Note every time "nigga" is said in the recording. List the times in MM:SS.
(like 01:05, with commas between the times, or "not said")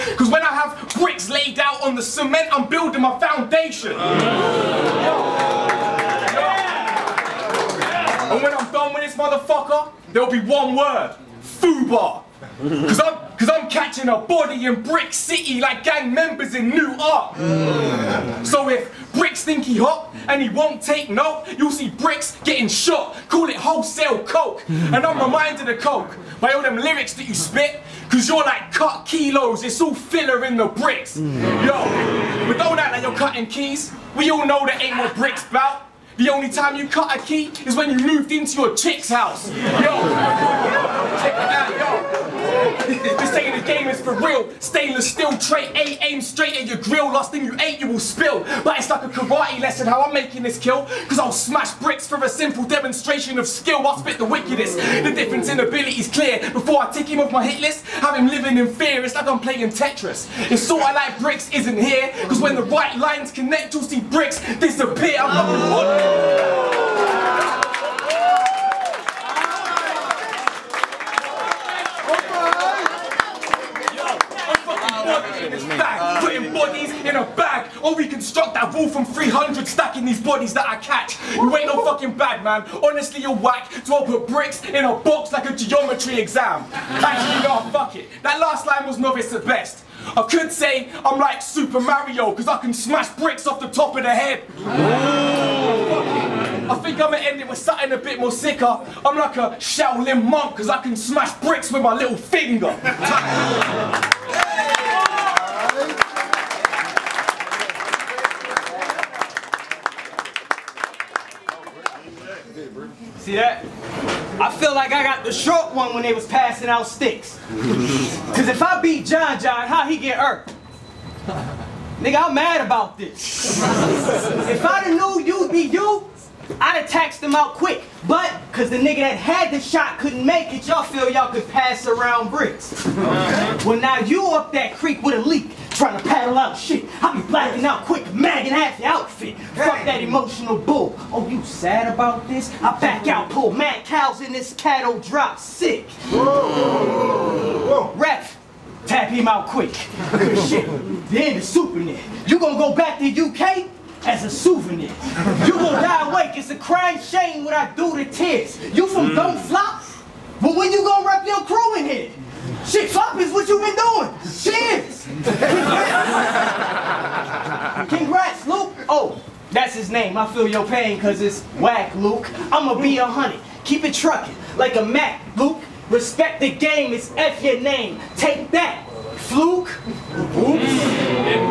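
02:02, 02:08.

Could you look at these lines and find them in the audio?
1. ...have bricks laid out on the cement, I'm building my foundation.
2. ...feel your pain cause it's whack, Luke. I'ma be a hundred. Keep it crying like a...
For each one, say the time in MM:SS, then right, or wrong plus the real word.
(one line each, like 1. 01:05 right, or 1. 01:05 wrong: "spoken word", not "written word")
1. 00:00 right
2. 02:50 wrong: "trucking", not "crying".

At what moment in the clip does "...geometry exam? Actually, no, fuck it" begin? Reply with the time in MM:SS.
01:25.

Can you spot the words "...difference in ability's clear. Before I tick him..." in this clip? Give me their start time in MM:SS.
00:55.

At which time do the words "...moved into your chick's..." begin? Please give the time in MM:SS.
00:38.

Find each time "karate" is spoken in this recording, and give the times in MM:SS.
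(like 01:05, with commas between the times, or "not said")
00:49.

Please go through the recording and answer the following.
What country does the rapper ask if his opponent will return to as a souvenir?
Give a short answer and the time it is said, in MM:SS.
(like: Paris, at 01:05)
UK, at 02:33.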